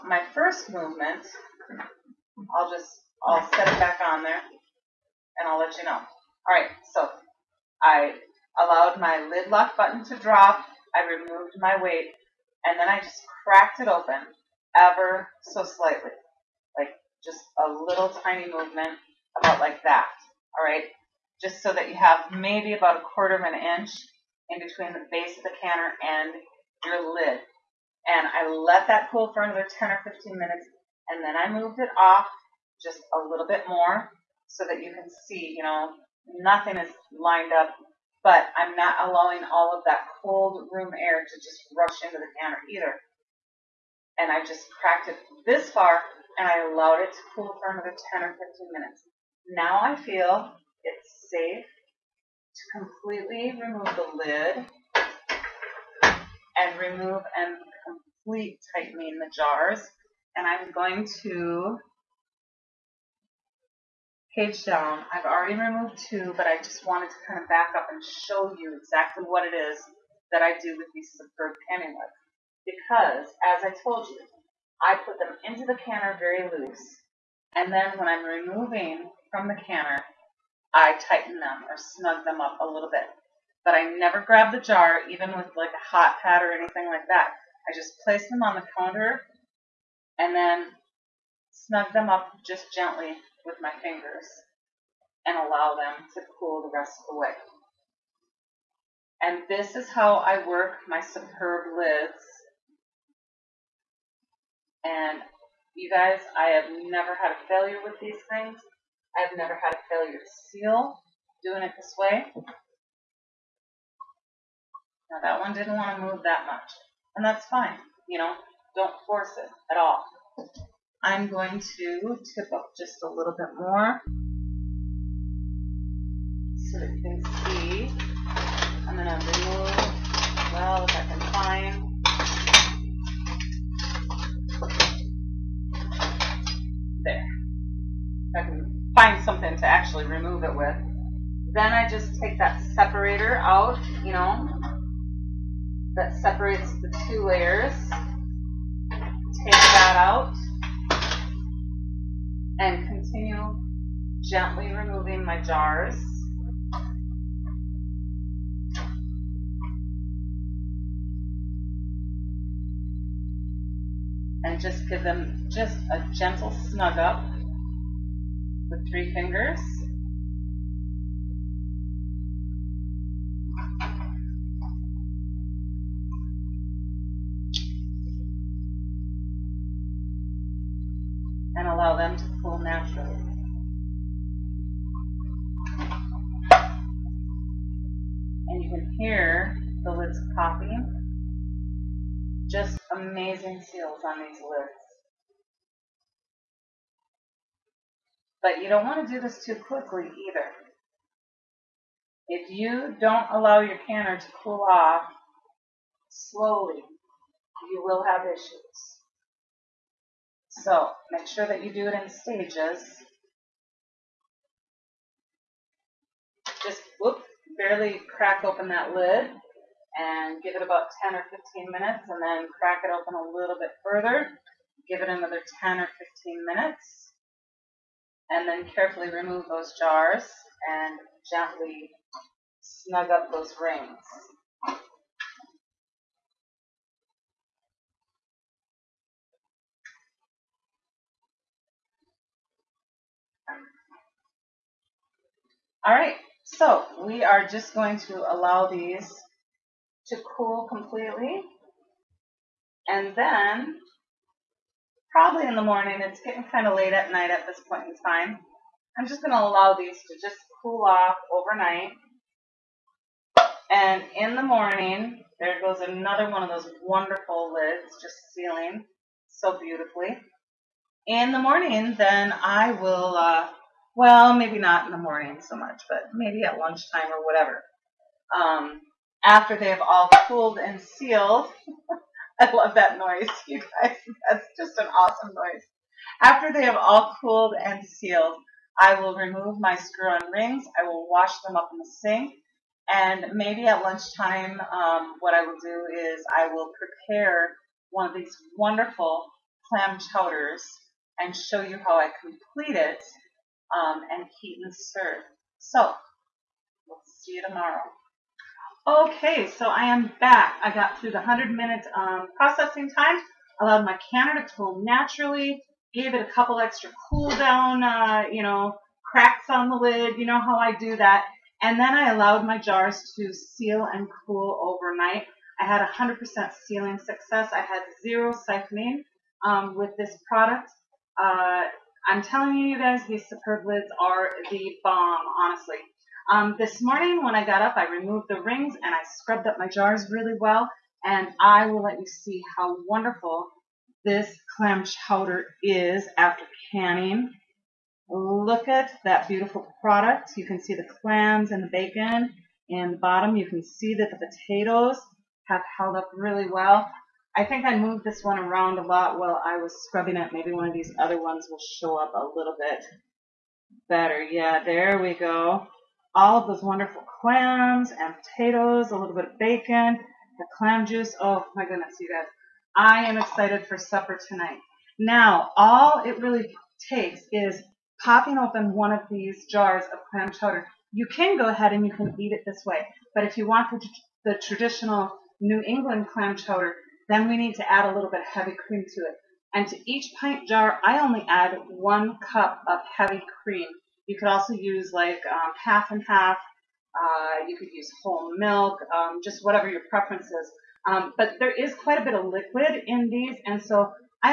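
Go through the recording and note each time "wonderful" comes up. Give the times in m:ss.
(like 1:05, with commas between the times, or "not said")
4:26, 4:58, 5:42, 6:06.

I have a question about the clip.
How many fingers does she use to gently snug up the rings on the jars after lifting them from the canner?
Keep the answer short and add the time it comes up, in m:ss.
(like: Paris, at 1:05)
3, at 2:48.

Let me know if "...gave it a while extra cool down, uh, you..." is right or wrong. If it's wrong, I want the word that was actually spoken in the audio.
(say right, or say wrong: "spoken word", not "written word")
wrong: "couple", not "while".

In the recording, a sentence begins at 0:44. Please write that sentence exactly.
And I just cracked it this far and I allowed it to cool for another 10 or 15 minutes.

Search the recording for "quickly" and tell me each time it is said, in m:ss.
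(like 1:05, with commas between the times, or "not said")
3:19.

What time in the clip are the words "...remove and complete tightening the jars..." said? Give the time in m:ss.
0:56.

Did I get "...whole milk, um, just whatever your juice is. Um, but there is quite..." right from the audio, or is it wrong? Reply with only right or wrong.
wrong.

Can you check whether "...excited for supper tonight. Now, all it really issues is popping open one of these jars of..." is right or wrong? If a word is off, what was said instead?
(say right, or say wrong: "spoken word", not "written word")
wrong: "takes", not "issues".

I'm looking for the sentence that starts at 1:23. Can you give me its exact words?
But I never grab the jar, even with like a hot pad or anything like that.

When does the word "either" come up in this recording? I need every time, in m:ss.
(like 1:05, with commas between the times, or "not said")
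0:42, 3:20.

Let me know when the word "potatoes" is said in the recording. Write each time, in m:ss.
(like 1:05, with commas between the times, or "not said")
5:54, 6:08.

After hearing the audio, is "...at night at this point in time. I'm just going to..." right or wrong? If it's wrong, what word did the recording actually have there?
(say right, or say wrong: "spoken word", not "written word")
right.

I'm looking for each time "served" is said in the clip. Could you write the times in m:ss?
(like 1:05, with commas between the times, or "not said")
5:04.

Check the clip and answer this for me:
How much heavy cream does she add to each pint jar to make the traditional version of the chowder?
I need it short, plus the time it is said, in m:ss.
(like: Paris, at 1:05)
1 cup, at 6:31.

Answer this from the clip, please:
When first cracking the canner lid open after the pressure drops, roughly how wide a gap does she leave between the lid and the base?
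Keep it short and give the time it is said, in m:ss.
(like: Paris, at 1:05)
a quarter of an inch, at 0:22.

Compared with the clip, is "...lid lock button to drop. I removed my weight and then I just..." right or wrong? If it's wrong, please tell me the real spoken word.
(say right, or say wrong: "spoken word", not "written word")
right.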